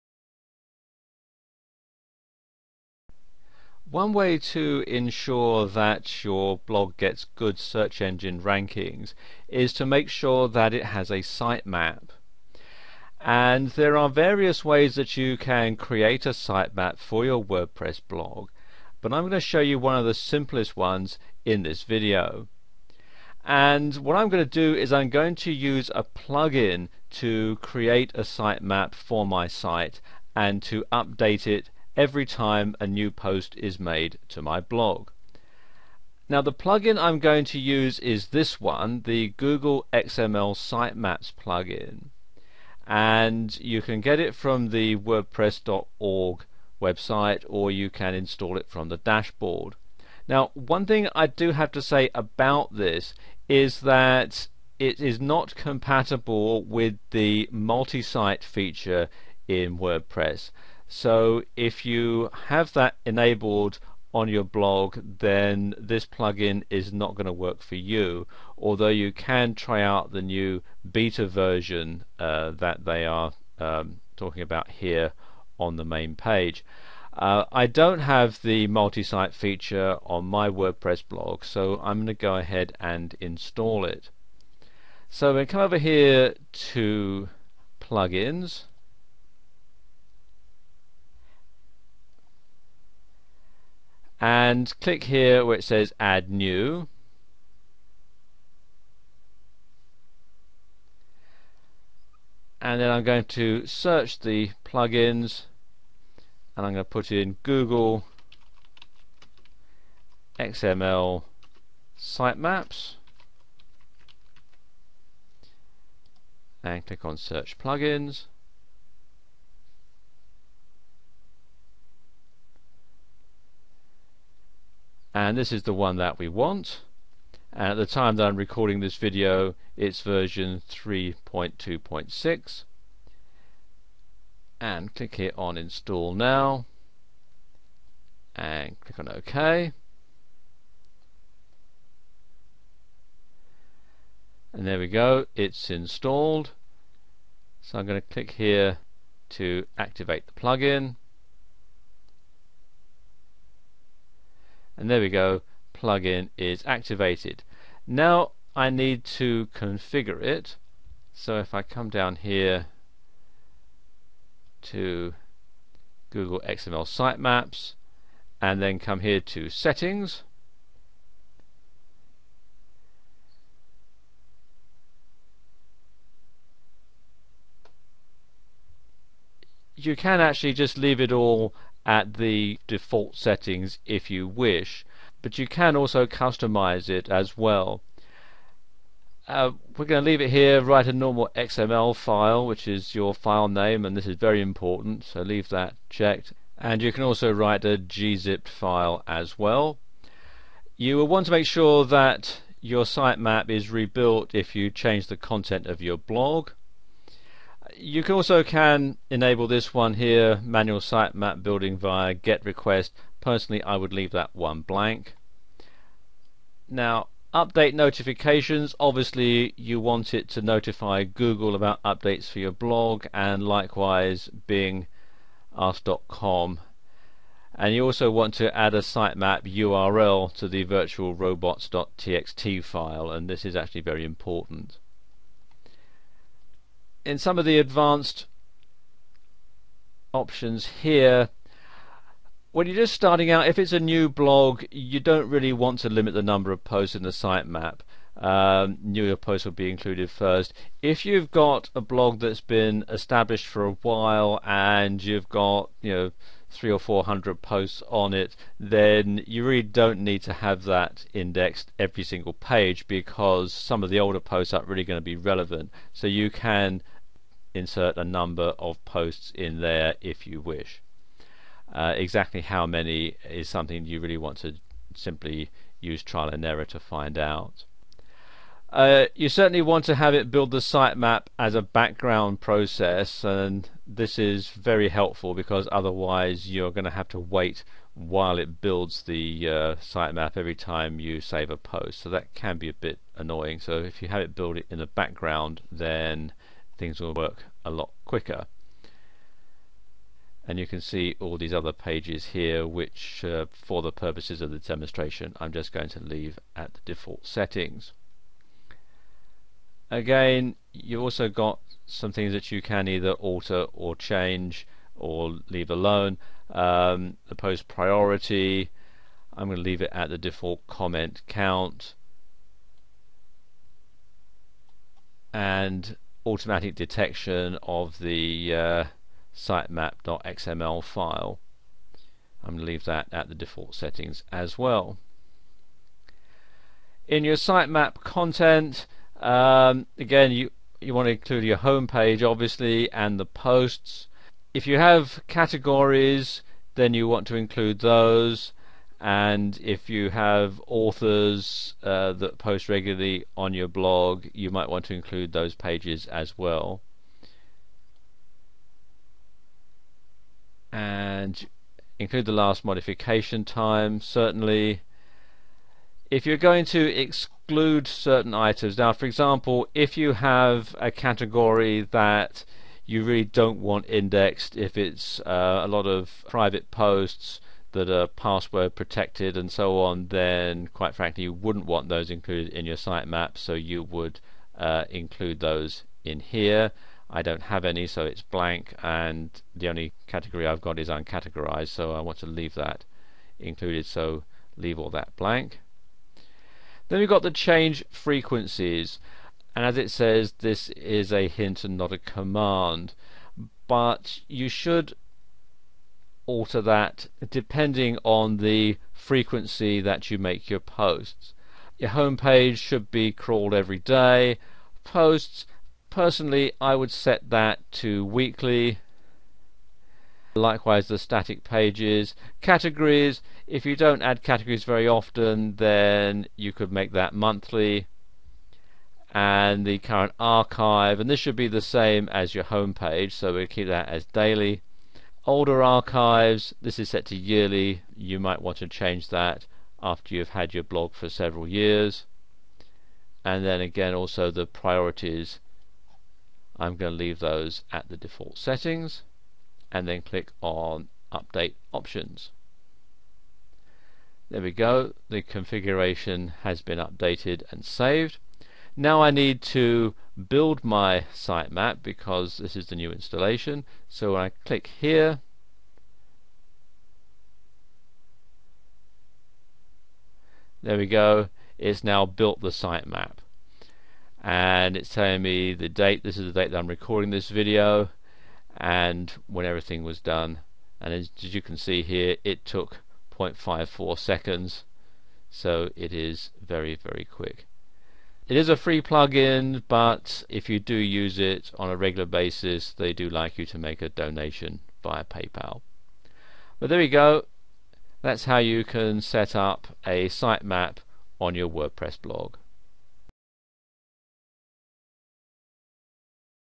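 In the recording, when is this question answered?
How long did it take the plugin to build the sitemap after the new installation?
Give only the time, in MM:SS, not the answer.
08:03.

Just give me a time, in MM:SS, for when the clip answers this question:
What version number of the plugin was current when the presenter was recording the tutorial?
02:10.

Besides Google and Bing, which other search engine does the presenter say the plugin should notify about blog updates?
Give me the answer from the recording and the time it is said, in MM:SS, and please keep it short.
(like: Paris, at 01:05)
ask.com, at 03:45.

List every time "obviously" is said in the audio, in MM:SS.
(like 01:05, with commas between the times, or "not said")
03:38, 05:42.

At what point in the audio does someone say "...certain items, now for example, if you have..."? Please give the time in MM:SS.
06:07.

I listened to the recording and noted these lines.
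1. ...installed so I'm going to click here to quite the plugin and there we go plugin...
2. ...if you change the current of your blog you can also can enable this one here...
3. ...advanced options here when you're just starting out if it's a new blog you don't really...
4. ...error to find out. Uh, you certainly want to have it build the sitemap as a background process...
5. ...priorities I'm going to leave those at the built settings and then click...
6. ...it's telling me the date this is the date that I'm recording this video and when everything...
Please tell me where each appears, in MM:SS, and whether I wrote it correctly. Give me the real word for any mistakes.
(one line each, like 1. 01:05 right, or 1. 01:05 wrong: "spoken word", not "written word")
1. 02:25 wrong: "activate", not "quite"
2. 03:24 wrong: "content", not "current"
3. 03:57 right
4. 04:36 right
5. 07:24 wrong: "default", not "built"
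6. 07:54 right.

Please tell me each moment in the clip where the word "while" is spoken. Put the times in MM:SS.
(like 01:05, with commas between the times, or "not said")
04:13, 04:47.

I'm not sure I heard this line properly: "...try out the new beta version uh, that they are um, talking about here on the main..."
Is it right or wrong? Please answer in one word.
right.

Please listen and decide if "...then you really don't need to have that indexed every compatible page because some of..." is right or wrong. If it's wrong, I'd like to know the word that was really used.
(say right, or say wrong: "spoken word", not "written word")
wrong: "single", not "compatible".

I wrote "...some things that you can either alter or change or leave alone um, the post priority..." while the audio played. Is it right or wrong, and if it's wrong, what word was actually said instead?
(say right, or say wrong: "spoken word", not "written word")
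right.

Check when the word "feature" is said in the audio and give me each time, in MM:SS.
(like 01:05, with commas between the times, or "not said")
00:58, 01:19.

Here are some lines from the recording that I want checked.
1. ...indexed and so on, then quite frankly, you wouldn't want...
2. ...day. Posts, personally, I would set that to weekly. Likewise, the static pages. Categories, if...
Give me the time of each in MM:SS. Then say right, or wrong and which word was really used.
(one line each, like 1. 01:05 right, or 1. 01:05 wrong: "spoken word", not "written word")
1. 06:18 wrong: "protected", not "indexed"
2. 06:53 right.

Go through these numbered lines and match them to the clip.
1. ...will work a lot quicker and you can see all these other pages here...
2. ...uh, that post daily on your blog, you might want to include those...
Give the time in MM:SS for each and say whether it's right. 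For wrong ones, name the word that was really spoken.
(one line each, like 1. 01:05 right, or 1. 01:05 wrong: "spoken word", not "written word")
1. 04:56 right
2. 05:51 wrong: "regularly", not "daily".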